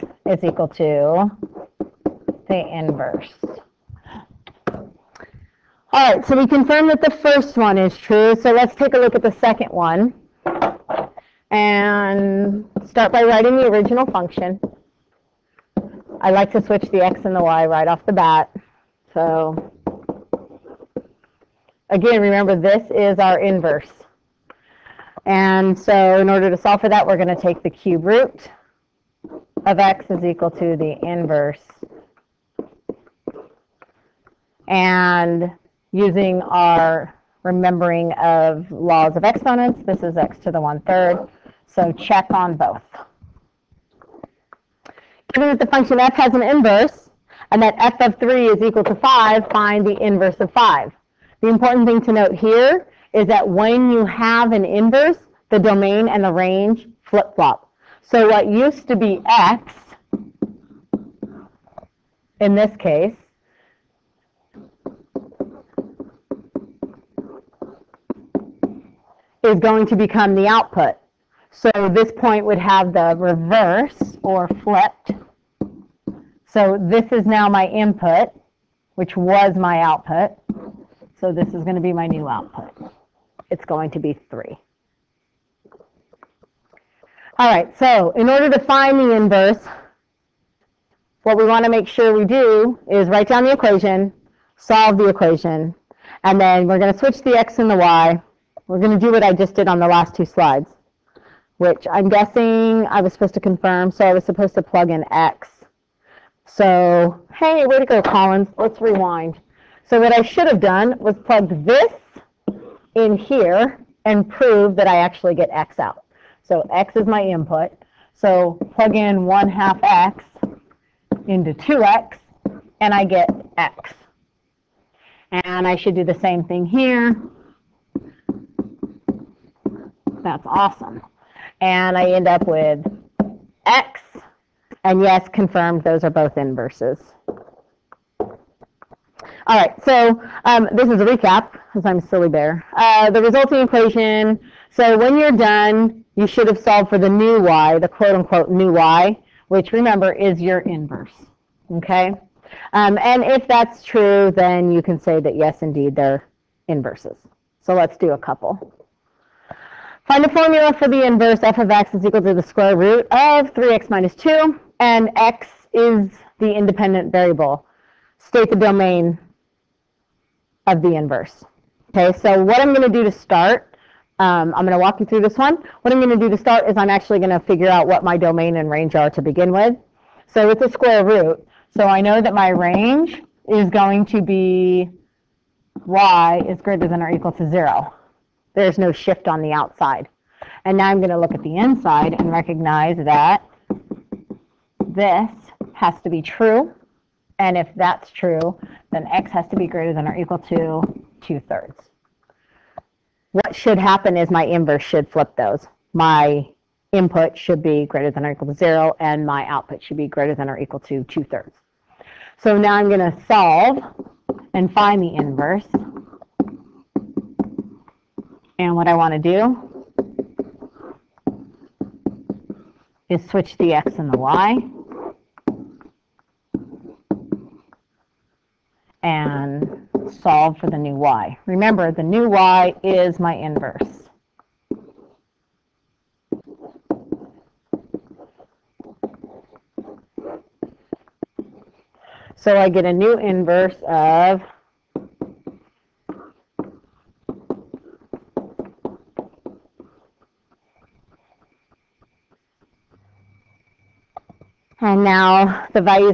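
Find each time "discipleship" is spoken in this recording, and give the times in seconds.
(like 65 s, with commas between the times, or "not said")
not said.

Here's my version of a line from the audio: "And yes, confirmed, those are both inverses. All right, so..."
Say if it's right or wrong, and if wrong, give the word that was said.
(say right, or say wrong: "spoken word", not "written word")
right.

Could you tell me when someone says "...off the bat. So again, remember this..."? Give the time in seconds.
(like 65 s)
17 s.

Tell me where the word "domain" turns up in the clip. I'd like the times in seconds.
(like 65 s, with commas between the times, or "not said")
55 s, 168 s, 178 s.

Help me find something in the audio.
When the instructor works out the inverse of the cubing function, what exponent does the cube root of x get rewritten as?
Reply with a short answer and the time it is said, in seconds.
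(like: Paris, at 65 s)
one-third, at 40 s.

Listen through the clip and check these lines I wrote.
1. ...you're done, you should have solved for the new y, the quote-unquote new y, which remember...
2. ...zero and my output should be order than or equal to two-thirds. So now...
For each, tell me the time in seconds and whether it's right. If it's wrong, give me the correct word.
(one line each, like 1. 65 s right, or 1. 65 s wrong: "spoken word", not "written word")
1. 145 s right
2. 208 s wrong: "greater", not "order".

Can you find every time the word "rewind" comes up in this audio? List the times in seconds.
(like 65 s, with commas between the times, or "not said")
108 s.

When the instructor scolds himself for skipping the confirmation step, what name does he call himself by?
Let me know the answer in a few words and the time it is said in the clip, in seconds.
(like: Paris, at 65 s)
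Collins, at 108 s.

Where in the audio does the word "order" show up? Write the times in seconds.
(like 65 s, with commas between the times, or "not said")
26 s, 88 s.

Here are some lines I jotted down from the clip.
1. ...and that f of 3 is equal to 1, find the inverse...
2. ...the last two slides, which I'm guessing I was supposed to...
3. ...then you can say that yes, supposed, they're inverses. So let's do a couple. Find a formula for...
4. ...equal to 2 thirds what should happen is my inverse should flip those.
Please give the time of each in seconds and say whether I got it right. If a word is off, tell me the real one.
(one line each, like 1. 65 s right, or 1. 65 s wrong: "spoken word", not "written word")
1. 47 s wrong: "5", not "1"
2. 99 s right
3. 154 s wrong: "indeed", not "supposed"
4. 200 s right.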